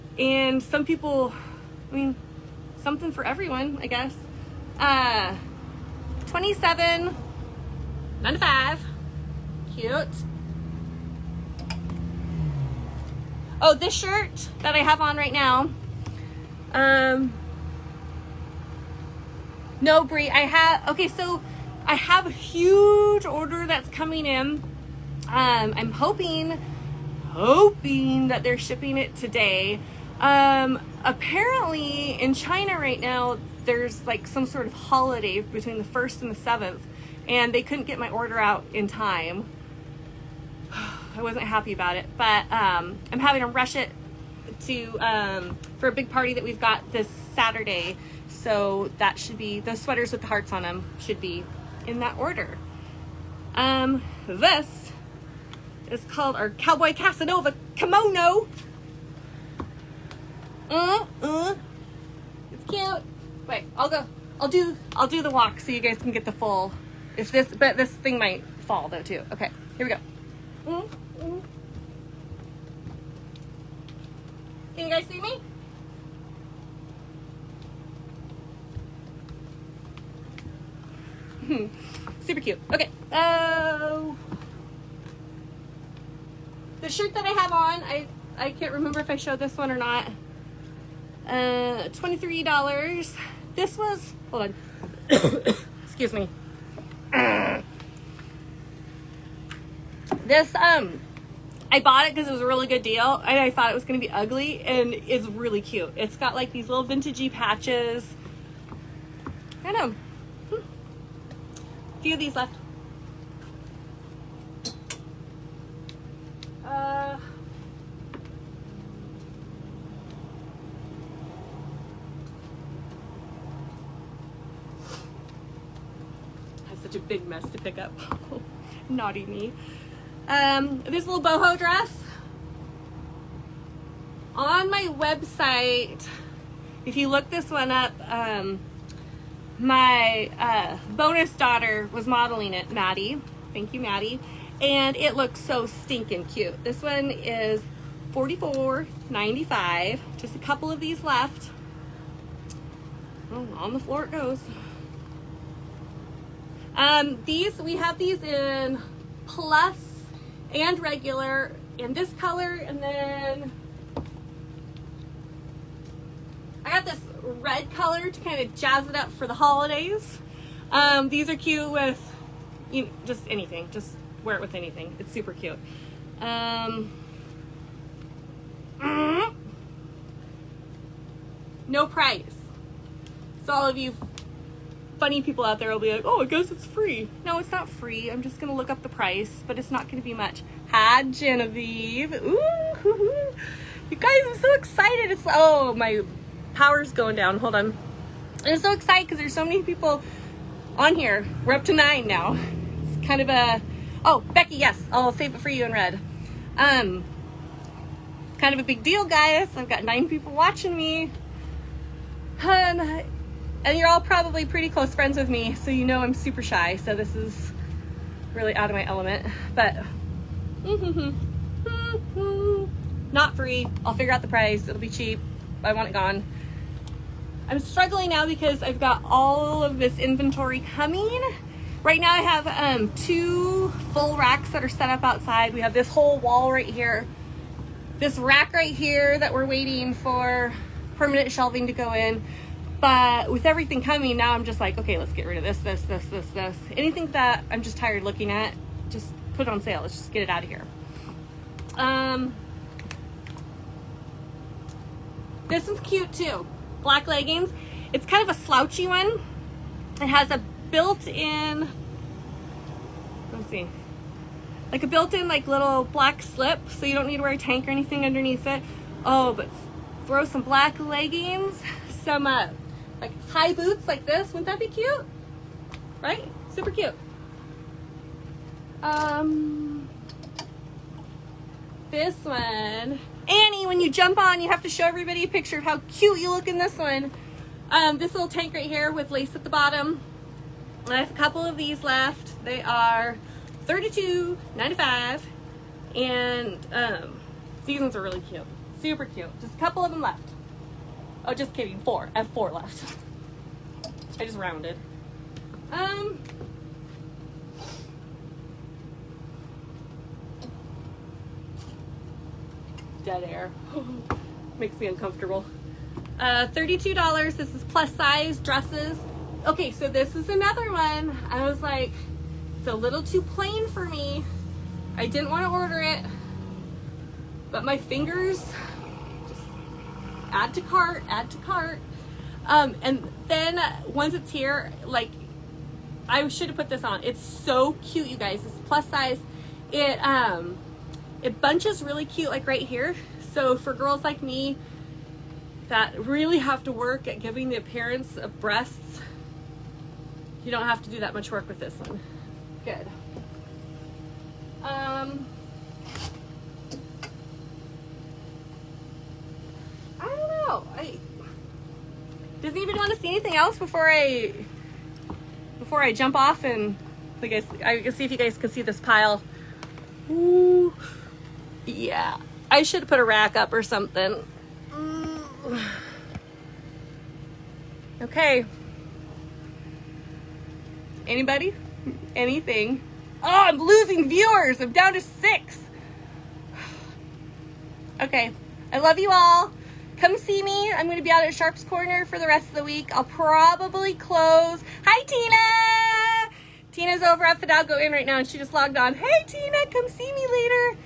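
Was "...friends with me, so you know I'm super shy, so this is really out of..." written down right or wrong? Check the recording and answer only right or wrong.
right.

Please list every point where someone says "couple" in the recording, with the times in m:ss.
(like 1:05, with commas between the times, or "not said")
2:30, 4:51, 4:59.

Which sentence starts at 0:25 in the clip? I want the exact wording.
Um, I'm hoping, hoping that they're shipping it today.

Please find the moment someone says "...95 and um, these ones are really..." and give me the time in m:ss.
4:54.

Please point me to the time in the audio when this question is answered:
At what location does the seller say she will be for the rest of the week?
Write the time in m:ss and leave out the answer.
6:31.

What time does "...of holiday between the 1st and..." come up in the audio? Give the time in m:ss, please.
0:34.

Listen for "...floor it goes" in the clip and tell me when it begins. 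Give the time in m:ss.
2:33.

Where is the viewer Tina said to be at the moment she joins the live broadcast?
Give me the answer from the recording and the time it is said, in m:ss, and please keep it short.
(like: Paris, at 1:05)
Fidalgo Inn, at 6:37.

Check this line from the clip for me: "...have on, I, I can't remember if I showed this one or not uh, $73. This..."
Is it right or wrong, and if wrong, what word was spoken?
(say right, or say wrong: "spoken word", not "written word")
wrong: "23", not "73".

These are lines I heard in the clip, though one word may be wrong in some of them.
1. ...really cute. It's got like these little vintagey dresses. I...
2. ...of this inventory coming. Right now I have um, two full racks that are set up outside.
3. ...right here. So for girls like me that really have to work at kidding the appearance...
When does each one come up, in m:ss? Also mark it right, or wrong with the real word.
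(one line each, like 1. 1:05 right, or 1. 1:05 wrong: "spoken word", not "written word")
1. 1:45 wrong: "patches", not "dresses"
2. 3:49 right
3. 5:42 wrong: "giving", not "kidding".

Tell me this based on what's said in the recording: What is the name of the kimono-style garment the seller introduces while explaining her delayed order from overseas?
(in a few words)
Cowboy Casanova Kimono.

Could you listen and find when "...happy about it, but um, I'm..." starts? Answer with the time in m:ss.
0:41.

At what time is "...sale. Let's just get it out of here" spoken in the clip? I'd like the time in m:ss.
4:09.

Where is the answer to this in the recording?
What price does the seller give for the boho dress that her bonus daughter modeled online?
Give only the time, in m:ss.
2:28.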